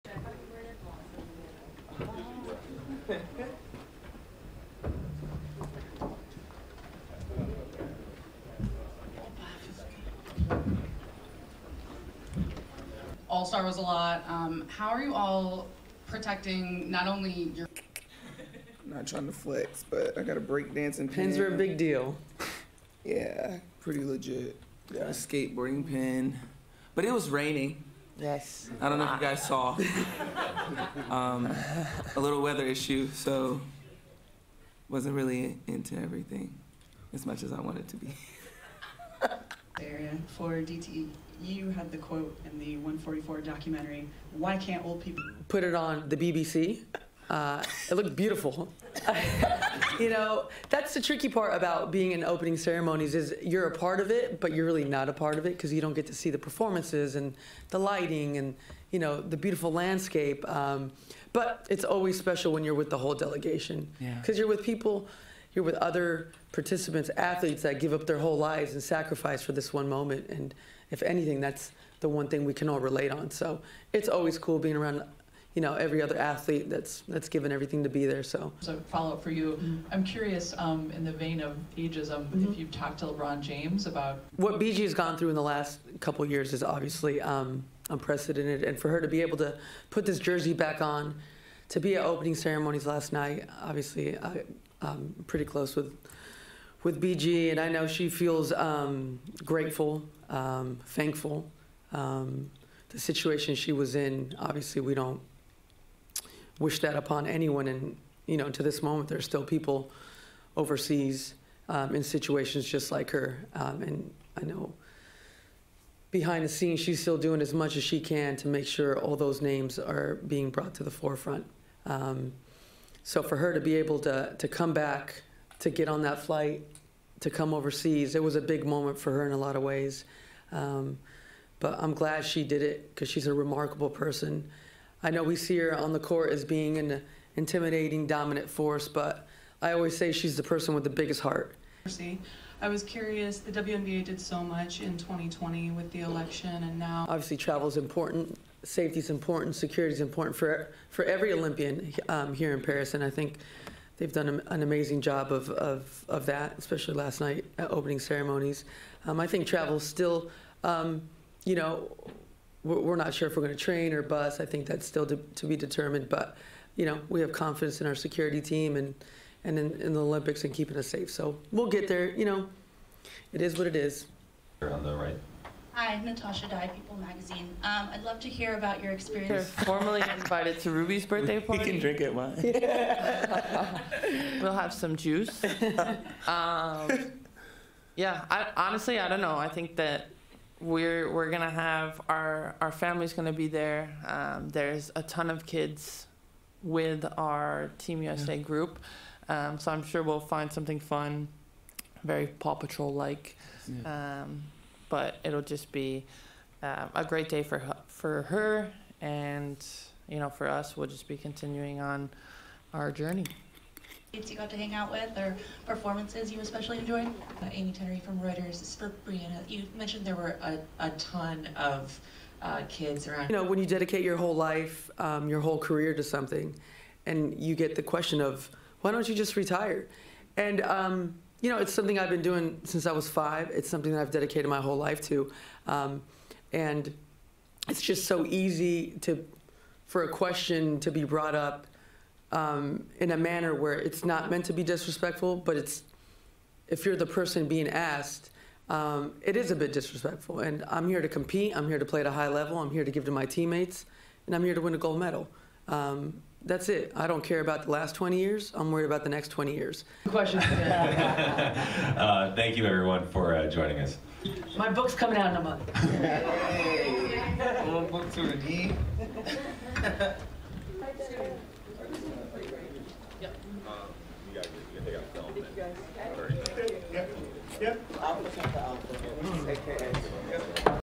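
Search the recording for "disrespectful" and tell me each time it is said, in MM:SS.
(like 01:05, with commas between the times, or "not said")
04:04, 04:09.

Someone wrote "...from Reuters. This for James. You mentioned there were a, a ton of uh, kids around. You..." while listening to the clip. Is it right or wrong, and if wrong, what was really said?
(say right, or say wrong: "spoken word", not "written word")
wrong: "Breanna", not "James".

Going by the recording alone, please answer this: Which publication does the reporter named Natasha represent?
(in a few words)
People Magazine.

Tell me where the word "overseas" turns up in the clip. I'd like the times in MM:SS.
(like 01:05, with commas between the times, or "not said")
01:50, 02:07.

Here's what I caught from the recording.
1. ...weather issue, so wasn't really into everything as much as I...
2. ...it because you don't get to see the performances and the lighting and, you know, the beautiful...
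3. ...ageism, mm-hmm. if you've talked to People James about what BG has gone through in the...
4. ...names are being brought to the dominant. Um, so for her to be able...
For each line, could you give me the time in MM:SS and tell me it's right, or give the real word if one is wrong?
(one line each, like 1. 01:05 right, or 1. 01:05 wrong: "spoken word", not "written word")
1. 00:32 right
2. 00:55 right
3. 01:21 wrong: "LeBron", not "People"
4. 01:59 wrong: "forefront", not "dominant".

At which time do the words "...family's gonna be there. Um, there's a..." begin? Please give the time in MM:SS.
03:12.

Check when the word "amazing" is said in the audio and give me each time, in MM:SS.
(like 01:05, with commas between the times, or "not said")
02:34.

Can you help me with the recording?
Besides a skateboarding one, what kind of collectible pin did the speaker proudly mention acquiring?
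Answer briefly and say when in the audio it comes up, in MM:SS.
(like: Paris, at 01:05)
breakdancing pin, at 00:20.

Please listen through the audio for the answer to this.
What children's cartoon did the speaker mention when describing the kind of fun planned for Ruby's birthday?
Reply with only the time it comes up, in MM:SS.
03:22.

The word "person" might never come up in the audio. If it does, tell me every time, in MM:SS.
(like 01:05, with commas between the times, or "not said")
02:13, 02:20, 04:07.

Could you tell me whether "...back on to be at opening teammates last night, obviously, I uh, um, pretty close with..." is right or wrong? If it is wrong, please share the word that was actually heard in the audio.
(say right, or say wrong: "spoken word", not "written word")
wrong: "ceremonies", not "teammates".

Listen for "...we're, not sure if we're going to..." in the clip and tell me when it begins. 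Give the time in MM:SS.
02:42.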